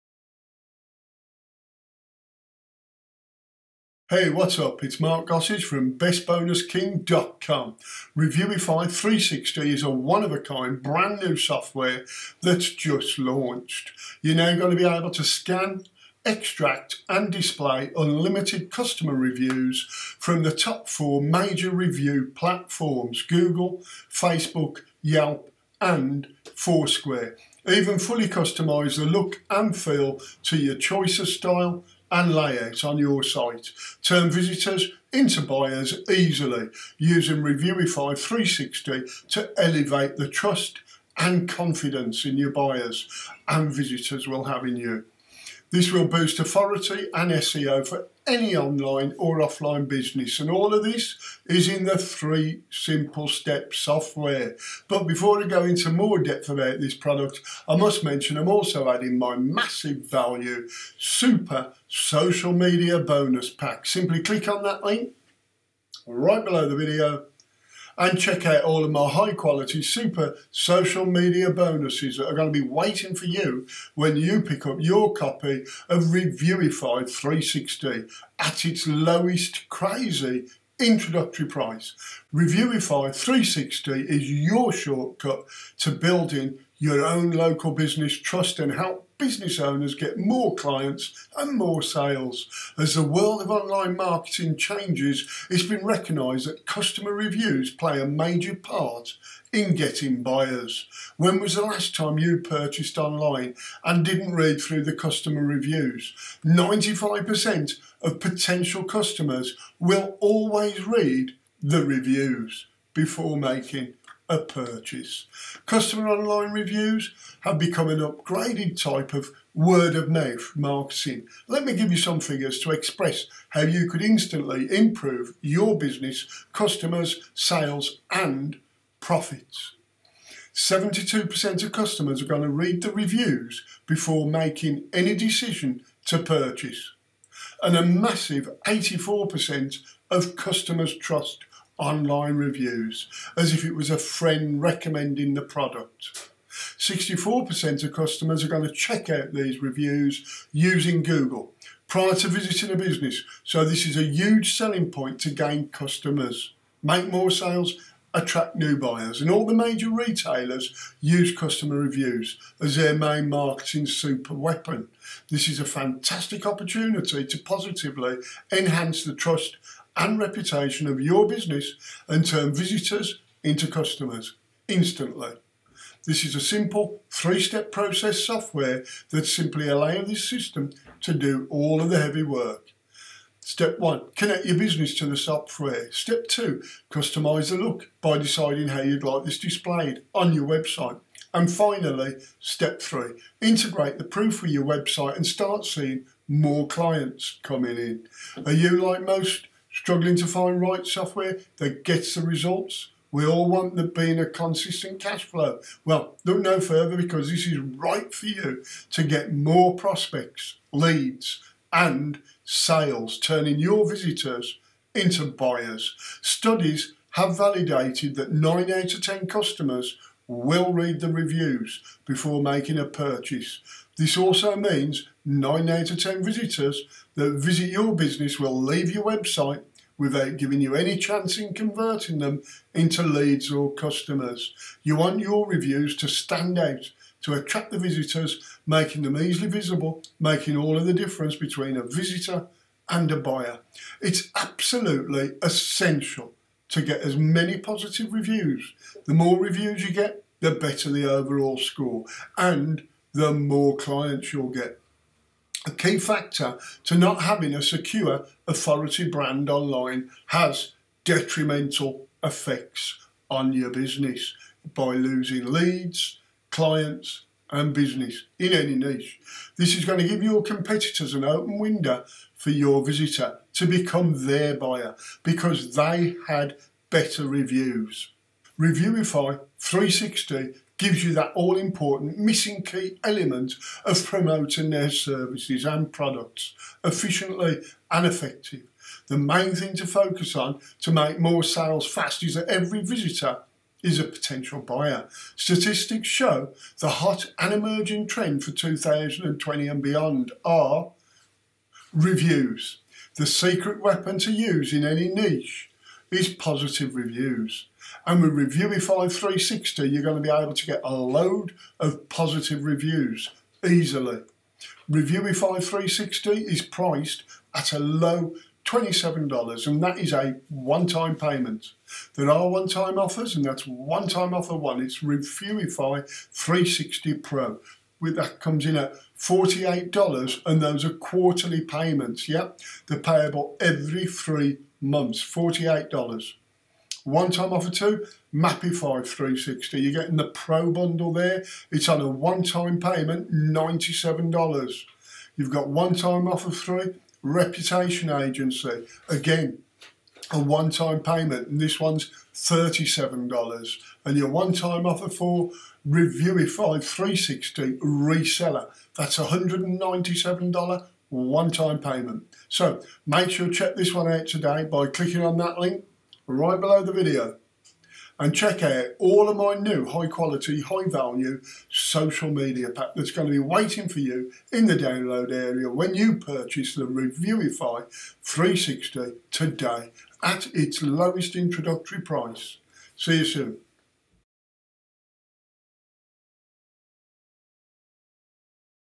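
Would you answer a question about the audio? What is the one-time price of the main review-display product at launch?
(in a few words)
$27.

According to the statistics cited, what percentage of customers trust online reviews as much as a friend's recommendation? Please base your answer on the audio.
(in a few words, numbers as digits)
84%.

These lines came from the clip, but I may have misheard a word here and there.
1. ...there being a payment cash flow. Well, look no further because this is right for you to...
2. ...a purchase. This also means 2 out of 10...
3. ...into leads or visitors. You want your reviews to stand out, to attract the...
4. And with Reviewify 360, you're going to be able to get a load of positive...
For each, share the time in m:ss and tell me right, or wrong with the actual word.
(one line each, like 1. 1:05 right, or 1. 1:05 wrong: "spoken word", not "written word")
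1. 3:23 wrong: "consistent", not "payment"
2. 3:42 wrong: "9", not "2"
3. 3:52 wrong: "customers", not "visitors"
4. 5:08 right.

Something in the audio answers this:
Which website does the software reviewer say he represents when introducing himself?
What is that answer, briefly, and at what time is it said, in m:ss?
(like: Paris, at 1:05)
BestBonusKing.com, at 0:05.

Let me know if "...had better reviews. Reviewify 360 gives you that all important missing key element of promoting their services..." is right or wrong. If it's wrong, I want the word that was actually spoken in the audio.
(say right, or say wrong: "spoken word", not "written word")
right.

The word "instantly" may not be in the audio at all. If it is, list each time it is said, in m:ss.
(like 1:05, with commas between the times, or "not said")
2:04, 2:54.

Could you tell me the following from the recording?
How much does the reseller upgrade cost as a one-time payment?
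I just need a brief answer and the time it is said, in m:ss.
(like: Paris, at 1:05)
$197, at 5:59.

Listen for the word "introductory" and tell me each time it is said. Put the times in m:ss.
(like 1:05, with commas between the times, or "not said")
1:20, 6:21.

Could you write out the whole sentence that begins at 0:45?
This will boost authority and SEO for any online or offline business.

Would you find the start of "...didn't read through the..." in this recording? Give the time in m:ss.
1:44.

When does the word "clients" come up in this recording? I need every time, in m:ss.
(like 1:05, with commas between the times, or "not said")
1:30, 3:16, 4:13, 4:26.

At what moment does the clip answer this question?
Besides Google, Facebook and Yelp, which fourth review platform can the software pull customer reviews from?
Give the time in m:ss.
0:26.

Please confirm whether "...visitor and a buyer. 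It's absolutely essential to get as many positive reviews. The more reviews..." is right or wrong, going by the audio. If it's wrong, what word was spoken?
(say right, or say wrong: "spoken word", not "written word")
right.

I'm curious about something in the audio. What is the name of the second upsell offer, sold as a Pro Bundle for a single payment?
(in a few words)
Mapify 360.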